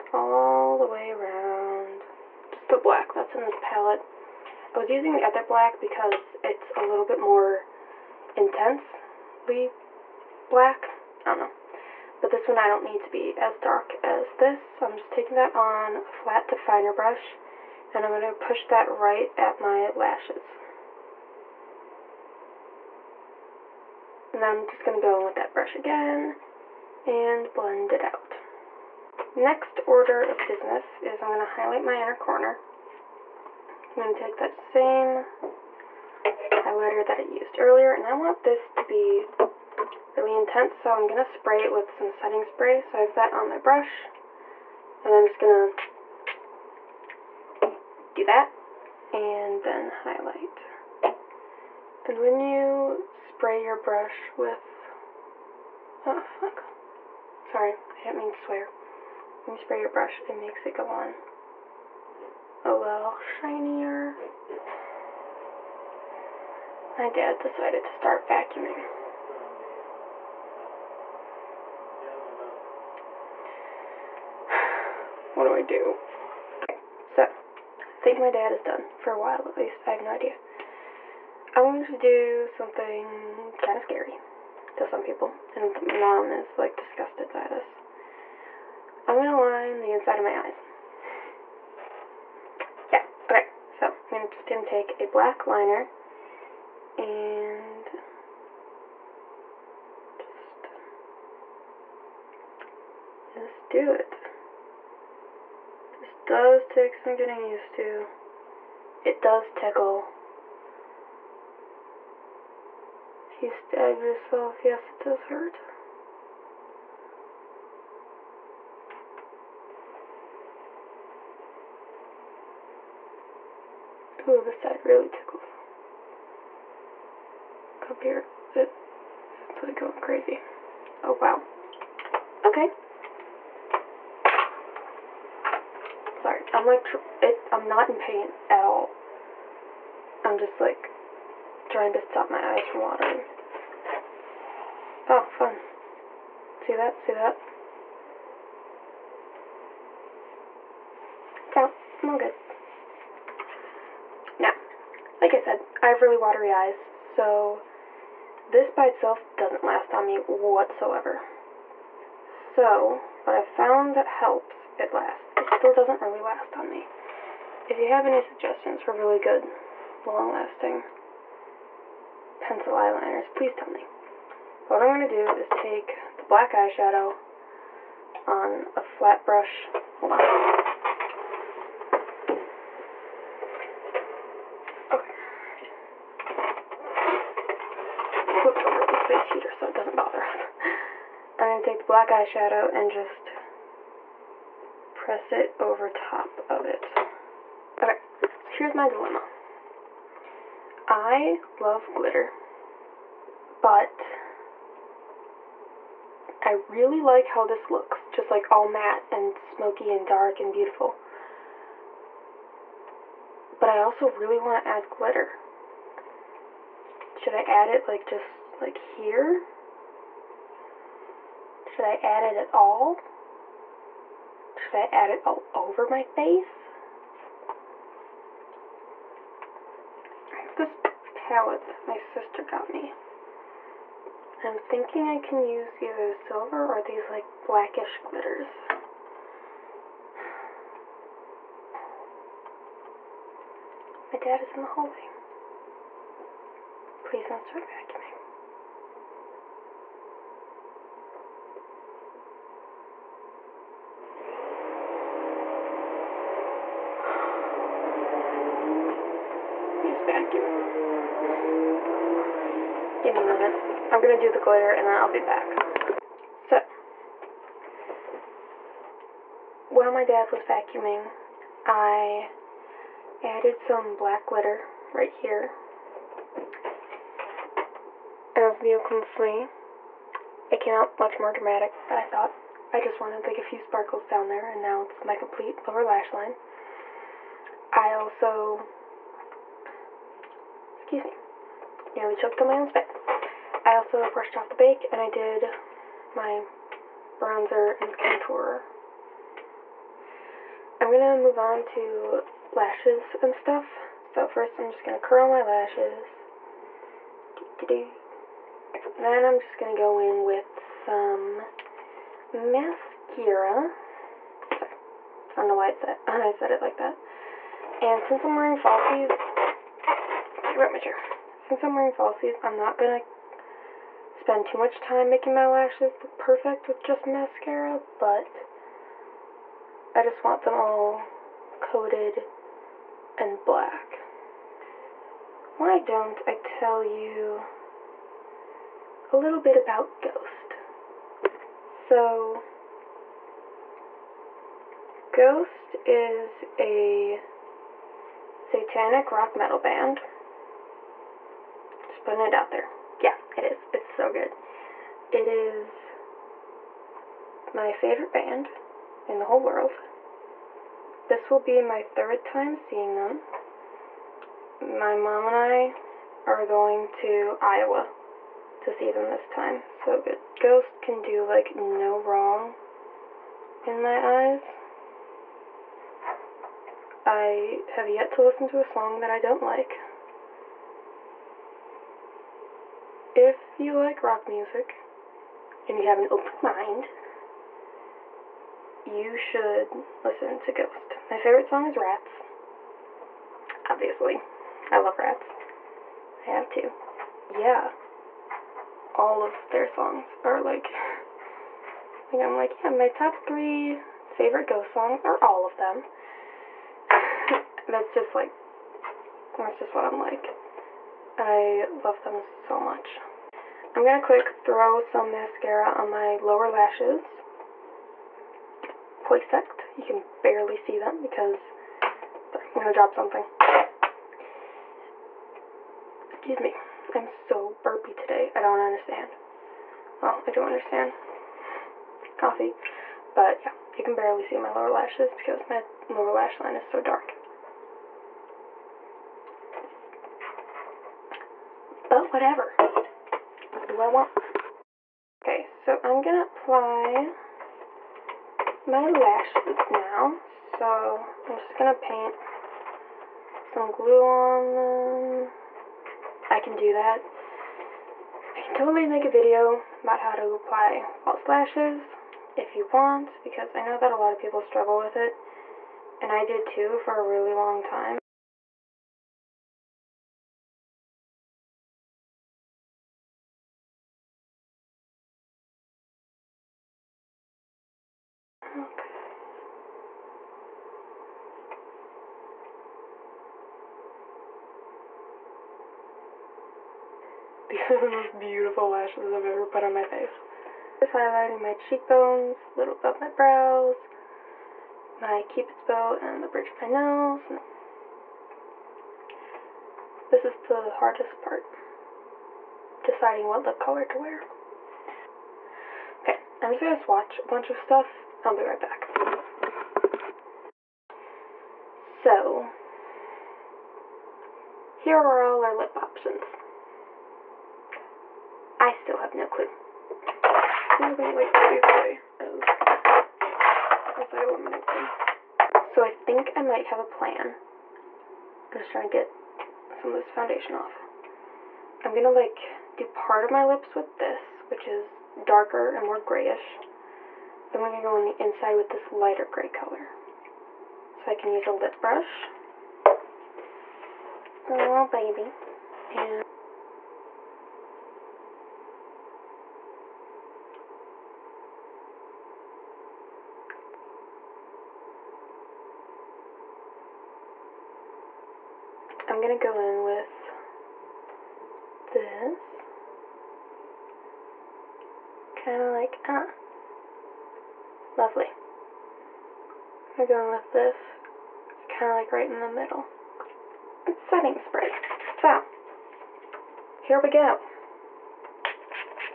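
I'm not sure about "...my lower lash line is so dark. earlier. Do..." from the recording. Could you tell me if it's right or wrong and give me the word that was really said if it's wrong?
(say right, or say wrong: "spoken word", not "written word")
wrong: "whatever", not "earlier".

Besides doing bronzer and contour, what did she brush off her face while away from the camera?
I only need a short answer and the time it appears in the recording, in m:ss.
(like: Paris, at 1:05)
The bake, at 4:54.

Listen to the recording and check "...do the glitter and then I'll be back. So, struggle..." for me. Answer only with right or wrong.
wrong.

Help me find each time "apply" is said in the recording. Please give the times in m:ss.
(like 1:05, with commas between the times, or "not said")
7:26, 7:40.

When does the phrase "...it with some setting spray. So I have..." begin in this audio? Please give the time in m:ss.
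0:41.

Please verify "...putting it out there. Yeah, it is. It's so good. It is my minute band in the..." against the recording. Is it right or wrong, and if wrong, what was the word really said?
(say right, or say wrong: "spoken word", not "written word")
wrong: "favorite", not "minute".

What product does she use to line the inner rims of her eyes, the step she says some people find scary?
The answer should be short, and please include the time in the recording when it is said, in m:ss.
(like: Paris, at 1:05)
Black liner, at 1:35.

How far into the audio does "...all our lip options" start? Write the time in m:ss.
8:35.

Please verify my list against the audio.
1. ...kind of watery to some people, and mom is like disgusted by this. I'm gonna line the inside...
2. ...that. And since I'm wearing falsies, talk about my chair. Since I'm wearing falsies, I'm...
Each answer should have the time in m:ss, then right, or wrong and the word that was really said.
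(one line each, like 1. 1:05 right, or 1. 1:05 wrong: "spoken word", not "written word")
1. 1:23 wrong: "scary", not "watery"
2. 5:16 right.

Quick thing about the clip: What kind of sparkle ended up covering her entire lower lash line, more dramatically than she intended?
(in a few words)
Black glitter.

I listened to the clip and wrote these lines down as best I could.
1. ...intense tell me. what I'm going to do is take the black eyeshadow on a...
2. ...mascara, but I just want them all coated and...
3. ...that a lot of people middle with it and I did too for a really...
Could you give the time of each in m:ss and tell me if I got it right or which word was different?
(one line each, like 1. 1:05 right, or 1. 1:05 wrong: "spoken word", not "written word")
1. 2:53 wrong: "please", not "intense"
2. 5:27 right
3. 7:43 wrong: "struggle", not "middle".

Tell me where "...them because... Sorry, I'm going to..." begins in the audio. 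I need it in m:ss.
7:00.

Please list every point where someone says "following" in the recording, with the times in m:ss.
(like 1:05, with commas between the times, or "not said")
not said.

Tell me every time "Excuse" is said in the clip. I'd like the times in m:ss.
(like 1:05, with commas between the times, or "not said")
4:50, 7:06.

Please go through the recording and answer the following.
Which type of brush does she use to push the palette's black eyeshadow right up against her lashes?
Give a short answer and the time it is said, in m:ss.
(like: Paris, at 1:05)
Flat definer brush, at 0:16.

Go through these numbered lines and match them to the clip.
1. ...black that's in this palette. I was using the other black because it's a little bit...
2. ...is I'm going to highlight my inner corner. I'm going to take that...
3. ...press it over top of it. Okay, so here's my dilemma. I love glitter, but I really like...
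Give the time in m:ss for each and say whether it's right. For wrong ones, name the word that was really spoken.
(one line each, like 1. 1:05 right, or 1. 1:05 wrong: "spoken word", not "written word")
1. 0:02 right
2. 0:31 right
3. 3:14 right.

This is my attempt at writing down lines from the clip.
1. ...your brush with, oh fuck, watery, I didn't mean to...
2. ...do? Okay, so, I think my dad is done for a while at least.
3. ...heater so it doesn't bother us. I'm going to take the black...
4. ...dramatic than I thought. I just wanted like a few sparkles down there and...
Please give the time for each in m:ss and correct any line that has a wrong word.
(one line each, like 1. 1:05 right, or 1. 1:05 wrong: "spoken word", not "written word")
1. 0:53 wrong: "sorry", not "watery"
2. 1:15 right
3. 3:09 right
4. 4:41 right.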